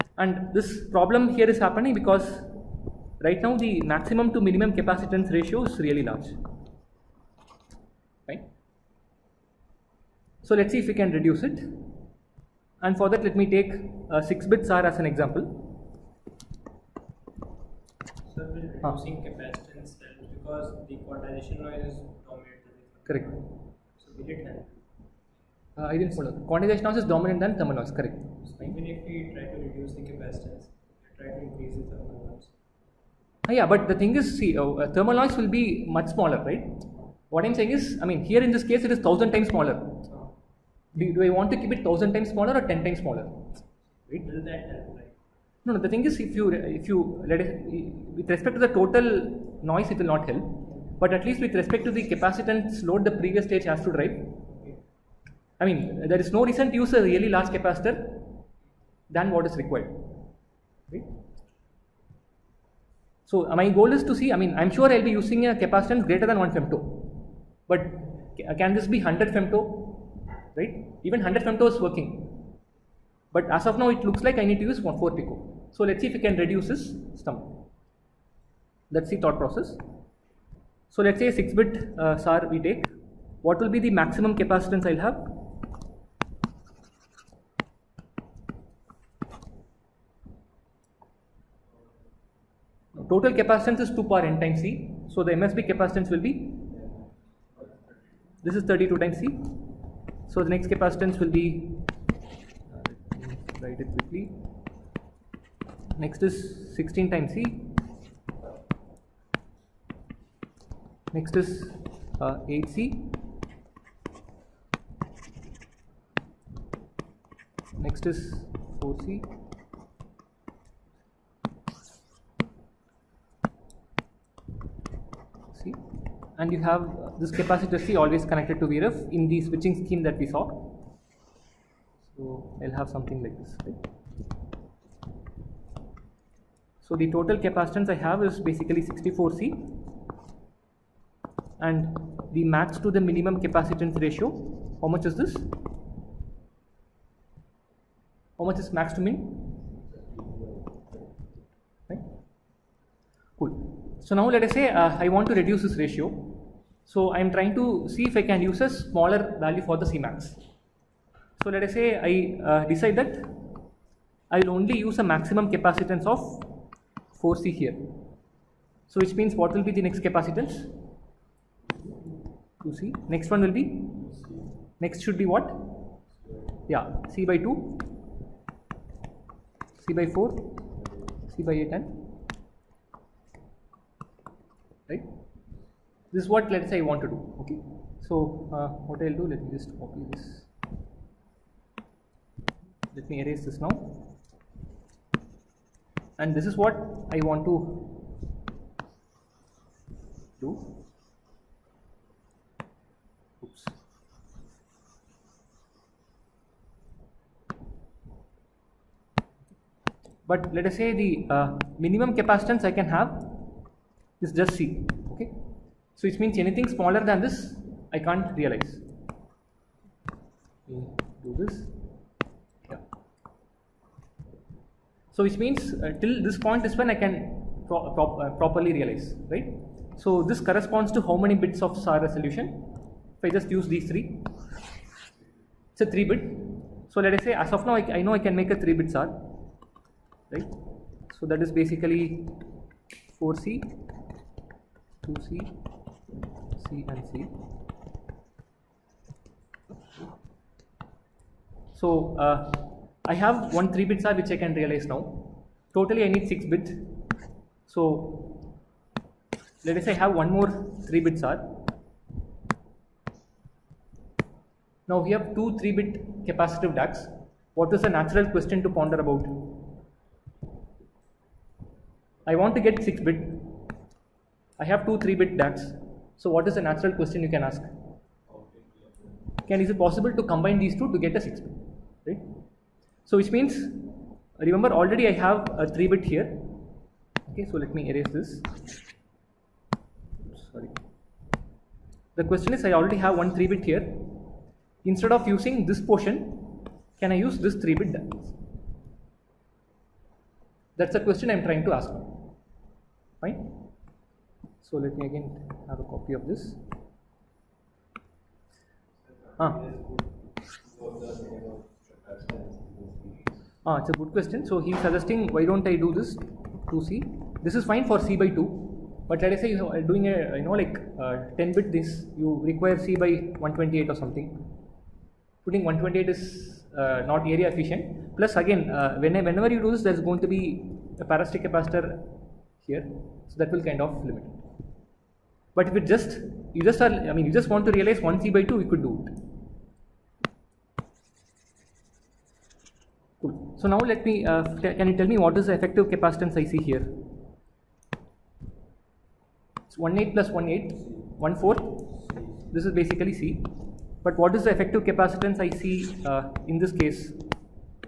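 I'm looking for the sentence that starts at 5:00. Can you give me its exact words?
That's the question I'm trying to ask.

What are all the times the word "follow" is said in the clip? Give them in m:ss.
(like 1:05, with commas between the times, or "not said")
0:26.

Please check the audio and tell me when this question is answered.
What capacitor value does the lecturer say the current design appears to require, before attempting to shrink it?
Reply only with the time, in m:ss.
1:14.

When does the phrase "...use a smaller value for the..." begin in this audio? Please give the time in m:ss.
2:38.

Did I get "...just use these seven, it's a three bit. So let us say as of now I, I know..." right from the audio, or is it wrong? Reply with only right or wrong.
wrong.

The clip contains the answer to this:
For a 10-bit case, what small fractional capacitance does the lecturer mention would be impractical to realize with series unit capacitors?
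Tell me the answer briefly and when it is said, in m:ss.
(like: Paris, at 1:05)
C/128, at 5:22.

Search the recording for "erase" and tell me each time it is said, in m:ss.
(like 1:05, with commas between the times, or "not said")
3:13, 4:47.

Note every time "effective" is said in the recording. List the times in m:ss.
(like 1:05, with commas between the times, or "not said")
5:45, 5:54.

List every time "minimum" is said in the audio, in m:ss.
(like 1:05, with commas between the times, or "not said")
0:04, 2:23, 3:31.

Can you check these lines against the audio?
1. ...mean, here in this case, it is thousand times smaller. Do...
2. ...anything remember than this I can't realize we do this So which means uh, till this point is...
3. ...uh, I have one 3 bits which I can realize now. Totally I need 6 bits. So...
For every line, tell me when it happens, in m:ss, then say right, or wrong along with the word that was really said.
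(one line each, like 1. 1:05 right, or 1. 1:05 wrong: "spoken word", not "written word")
1. 0:38 right
2. 3:36 wrong: "smaller", not "remember"
3. 4:12 right.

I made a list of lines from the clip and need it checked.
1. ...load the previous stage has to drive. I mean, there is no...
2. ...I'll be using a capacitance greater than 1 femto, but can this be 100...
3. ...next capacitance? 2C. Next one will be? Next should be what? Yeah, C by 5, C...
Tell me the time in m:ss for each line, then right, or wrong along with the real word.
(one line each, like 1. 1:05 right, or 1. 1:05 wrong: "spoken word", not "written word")
1. 0:52 right
2. 1:04 right
3. 2:49 wrong: "2", not "5".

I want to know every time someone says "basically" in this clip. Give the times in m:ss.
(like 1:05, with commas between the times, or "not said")
2:18, 4:01, 5:52.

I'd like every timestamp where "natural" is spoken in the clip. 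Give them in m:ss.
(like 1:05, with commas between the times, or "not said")
4:27, 4:36.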